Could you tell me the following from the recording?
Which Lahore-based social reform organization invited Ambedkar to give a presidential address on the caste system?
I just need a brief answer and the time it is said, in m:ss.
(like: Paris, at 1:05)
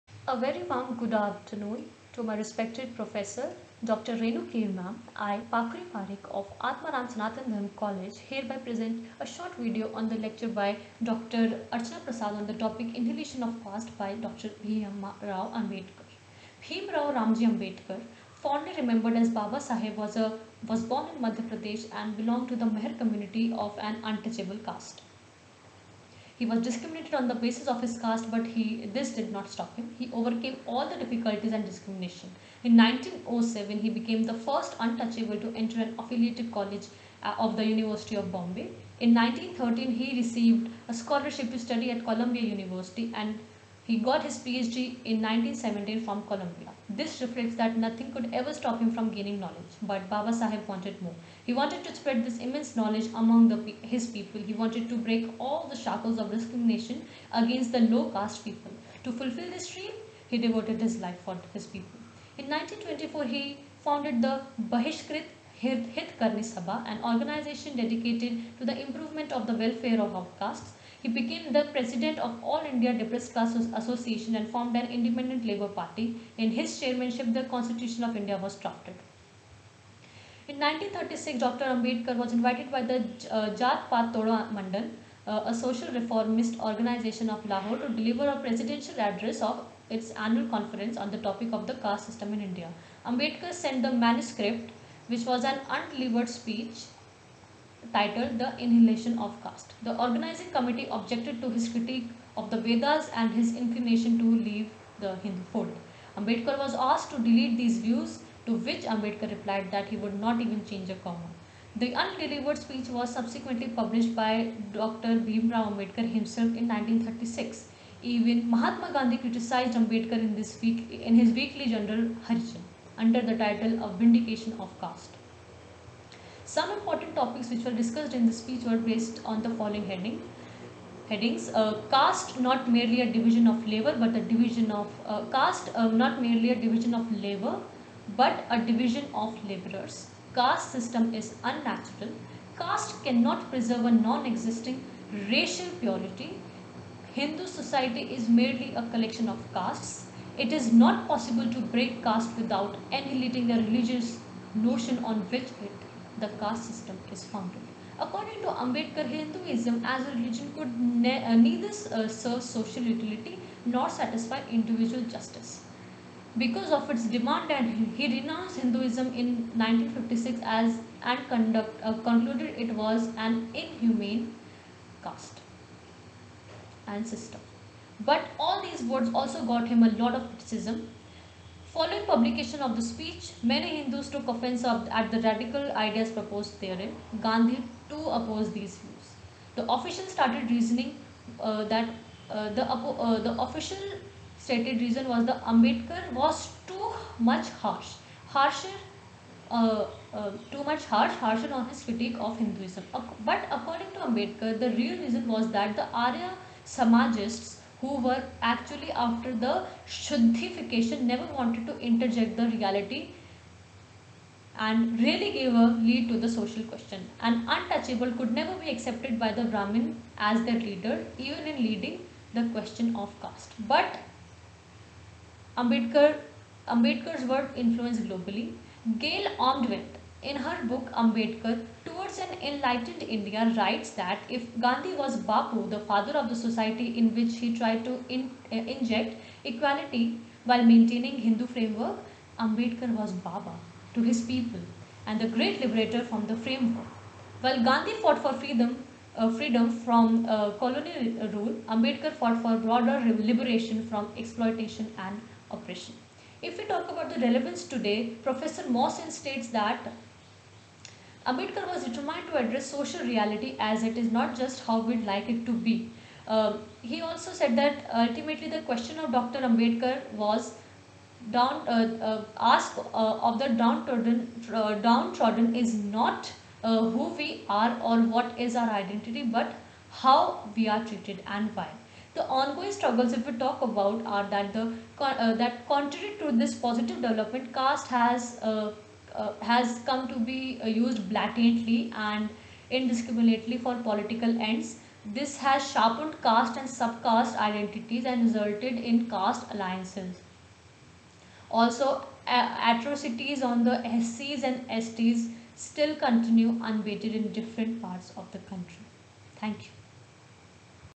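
Jat Path Mandal, at 1:23.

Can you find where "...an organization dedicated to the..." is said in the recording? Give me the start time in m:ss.
1:06.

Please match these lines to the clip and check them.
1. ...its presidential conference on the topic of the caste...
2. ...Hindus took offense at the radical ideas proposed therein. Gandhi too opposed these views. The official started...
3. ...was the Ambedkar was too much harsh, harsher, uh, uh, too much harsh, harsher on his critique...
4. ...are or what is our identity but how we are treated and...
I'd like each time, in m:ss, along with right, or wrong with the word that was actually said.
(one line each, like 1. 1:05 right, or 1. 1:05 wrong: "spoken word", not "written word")
1. 1:29 wrong: "annual", not "presidential"
2. 3:03 right
3. 3:15 right
4. 4:37 right.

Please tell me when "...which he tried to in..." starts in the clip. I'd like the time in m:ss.
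3:57.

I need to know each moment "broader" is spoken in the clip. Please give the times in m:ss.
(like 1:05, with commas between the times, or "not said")
4:12.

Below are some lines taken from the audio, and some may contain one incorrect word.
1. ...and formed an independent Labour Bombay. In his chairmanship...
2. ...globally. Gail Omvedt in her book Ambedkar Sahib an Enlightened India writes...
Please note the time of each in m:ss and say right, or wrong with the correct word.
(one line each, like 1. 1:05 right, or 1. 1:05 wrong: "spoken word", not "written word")
1. 1:14 wrong: "Party", not "Bombay"
2. 3:48 wrong: "Towards", not "Sahib".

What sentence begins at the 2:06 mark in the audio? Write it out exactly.
Some important topics which were discussed in the speech were based on the following heading.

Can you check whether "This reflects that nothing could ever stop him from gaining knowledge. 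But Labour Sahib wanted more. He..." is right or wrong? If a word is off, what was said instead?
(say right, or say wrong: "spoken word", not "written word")
wrong: "Baba", not "Labour".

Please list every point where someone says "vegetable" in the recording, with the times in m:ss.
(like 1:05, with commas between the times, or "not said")
not said.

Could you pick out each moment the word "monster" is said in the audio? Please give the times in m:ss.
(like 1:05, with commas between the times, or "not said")
not said.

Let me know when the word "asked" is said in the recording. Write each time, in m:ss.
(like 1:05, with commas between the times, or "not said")
1:46.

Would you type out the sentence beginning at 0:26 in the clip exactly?
He was discriminated on the basis of his caste, but he this did not stop him.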